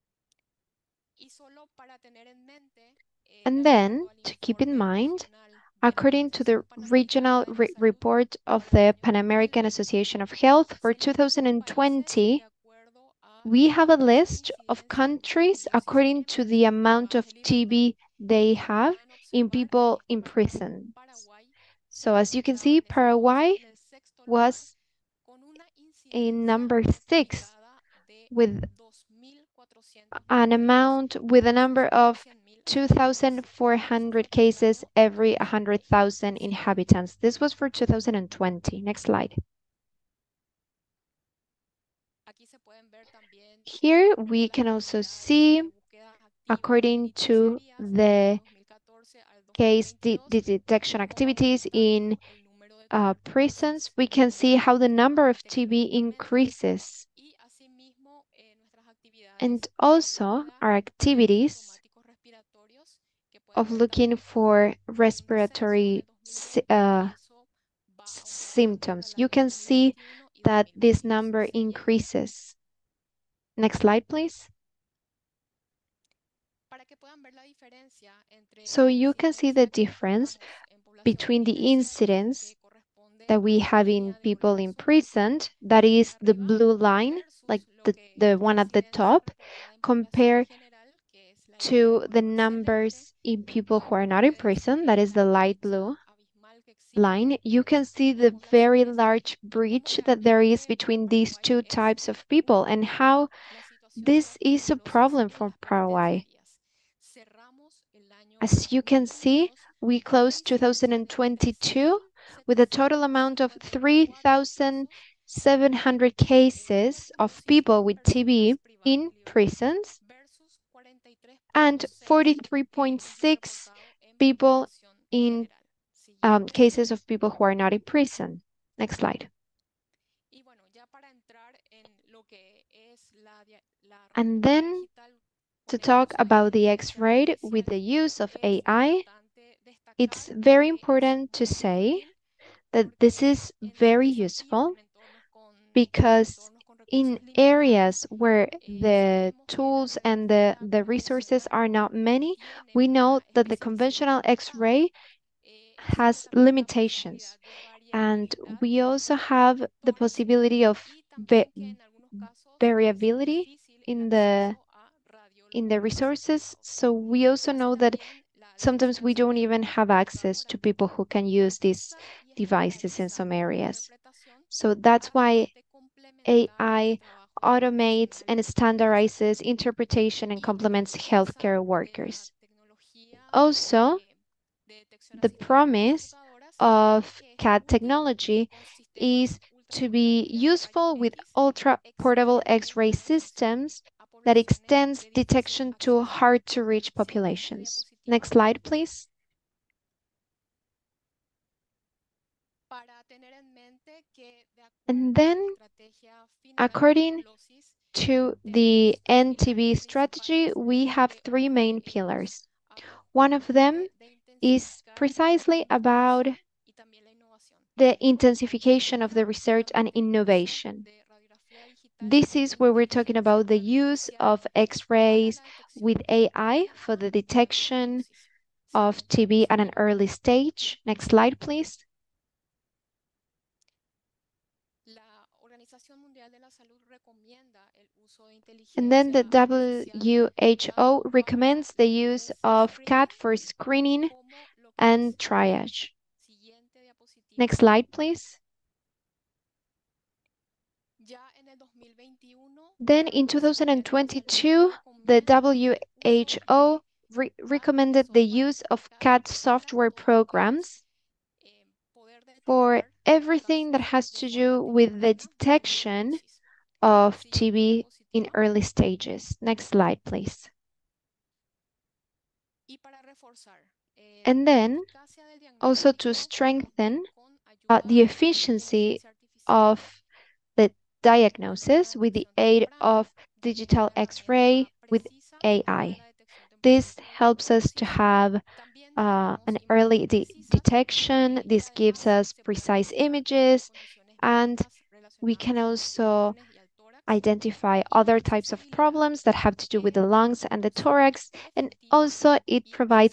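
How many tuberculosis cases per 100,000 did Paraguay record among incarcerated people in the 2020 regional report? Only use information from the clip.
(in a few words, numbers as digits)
2,400.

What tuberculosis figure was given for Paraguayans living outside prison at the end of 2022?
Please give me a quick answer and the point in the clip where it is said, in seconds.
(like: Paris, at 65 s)
43.6, at 122 s.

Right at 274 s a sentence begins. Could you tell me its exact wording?
And then also to strengthen uh, the efficiency of diagnosis with the aid of digital X-ray with AI.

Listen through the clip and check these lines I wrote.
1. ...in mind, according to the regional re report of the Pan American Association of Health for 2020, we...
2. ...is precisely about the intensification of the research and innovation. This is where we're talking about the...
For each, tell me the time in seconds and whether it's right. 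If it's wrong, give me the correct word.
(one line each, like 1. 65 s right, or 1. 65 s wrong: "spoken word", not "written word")
1. 4 s right
2. 214 s right.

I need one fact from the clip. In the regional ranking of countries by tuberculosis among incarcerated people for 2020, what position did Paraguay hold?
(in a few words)
6.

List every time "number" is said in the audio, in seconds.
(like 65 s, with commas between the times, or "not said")
26 s, 31 s, 54 s, 71 s, 92 s.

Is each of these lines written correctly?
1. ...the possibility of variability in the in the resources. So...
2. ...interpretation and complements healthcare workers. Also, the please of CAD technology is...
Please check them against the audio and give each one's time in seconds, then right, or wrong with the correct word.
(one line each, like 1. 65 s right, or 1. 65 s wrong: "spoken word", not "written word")
1. 159 s right
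2. 179 s wrong: "promise", not "please".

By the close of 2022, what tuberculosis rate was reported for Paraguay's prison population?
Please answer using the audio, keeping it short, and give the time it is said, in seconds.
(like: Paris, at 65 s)
3,700, at 113 s.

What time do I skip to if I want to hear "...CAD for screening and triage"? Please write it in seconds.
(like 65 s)
242 s.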